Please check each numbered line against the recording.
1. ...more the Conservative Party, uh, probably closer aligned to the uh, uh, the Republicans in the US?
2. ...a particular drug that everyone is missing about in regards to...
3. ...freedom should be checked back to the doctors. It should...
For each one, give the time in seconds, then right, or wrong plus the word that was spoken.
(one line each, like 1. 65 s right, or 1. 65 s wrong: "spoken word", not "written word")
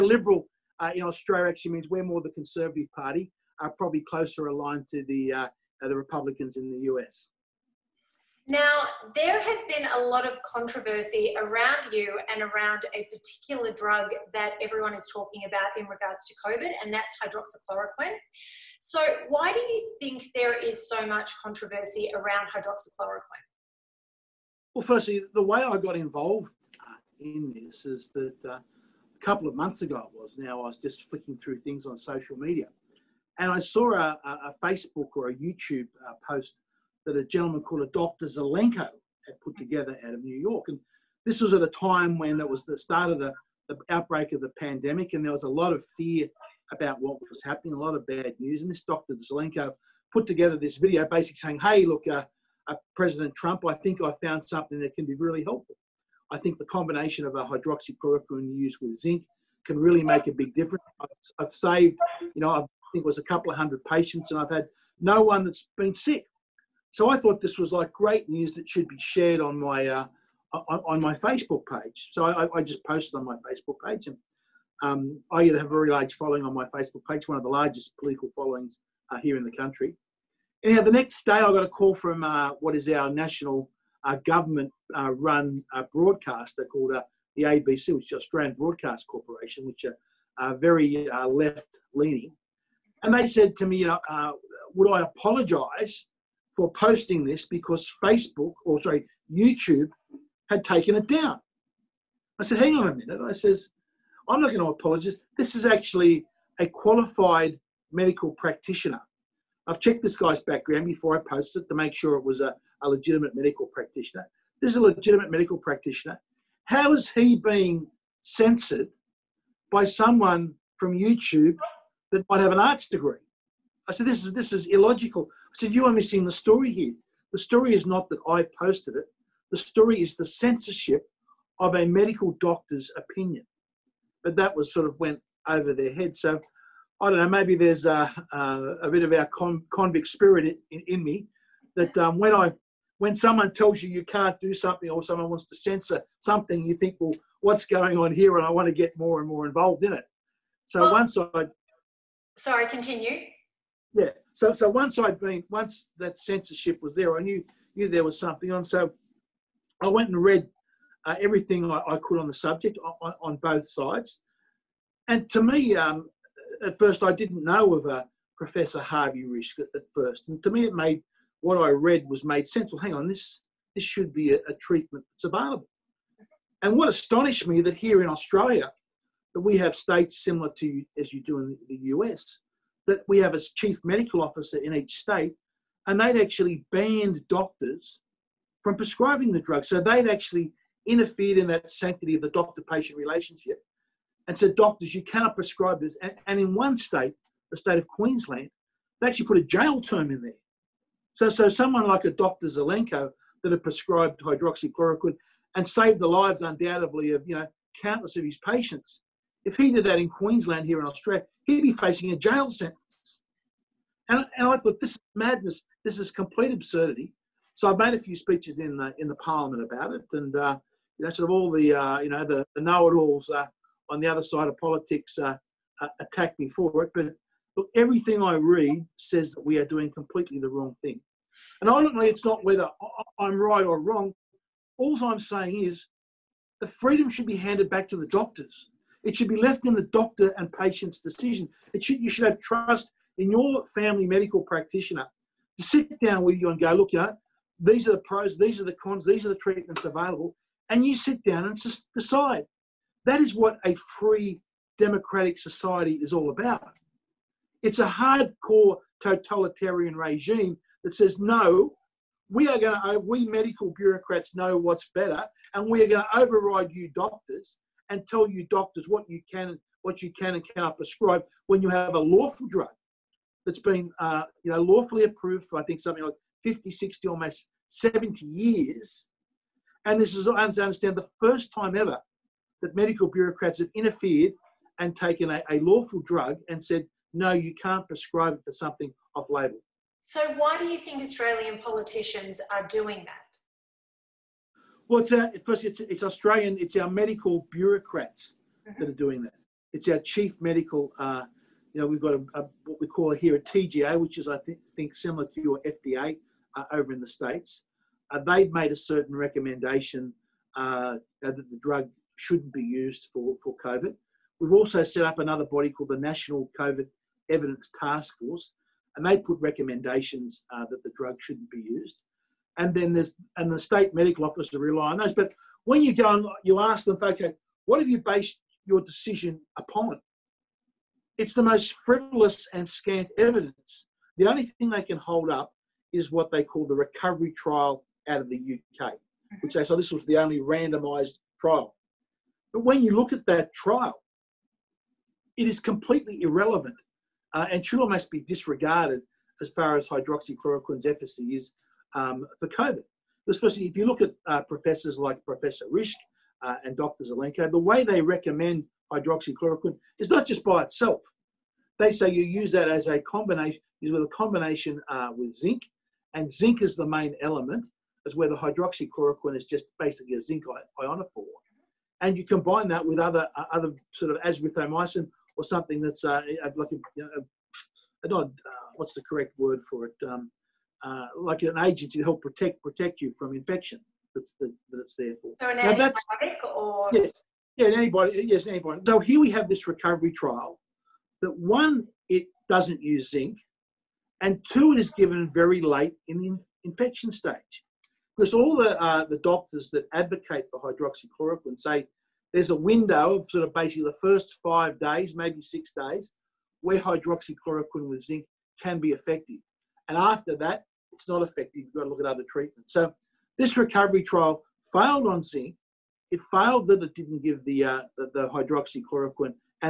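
1. 2 s right
2. 12 s wrong: "talking", not "missing"
3. 236 s wrong: "handed", not "checked".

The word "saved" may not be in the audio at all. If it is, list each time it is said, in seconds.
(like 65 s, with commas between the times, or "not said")
61 s, 205 s.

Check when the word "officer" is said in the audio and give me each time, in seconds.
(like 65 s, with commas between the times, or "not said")
184 s, 324 s.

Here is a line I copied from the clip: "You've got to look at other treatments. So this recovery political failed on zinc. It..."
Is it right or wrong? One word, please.
wrong.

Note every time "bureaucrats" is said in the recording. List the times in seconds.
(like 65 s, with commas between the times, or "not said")
263 s, 283 s, 297 s.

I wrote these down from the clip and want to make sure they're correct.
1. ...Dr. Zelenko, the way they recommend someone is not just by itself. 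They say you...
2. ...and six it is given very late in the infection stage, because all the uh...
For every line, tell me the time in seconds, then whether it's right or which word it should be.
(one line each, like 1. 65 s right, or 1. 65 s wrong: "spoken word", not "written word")
1. 356 s wrong: "hydroxychloroquine", not "someone"
2. 394 s wrong: "two", not "six".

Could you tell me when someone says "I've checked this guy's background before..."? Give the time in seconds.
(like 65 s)
109 s.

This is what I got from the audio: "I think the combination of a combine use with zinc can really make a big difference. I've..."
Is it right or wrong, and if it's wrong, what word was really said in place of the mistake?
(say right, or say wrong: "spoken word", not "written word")
wrong: "hydroxychloroquine", not "combine".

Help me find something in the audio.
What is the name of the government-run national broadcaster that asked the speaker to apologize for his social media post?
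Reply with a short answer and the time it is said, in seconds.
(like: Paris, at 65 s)
Australian Broadcast Corporation, at 88 s.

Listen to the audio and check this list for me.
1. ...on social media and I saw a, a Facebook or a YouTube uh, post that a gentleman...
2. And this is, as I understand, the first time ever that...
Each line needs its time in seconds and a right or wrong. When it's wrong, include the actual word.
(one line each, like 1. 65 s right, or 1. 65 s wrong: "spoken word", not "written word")
1. 31 s right
2. 279 s right.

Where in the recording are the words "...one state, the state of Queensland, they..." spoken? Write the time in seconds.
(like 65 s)
196 s.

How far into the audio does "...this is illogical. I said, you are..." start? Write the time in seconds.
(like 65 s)
124 s.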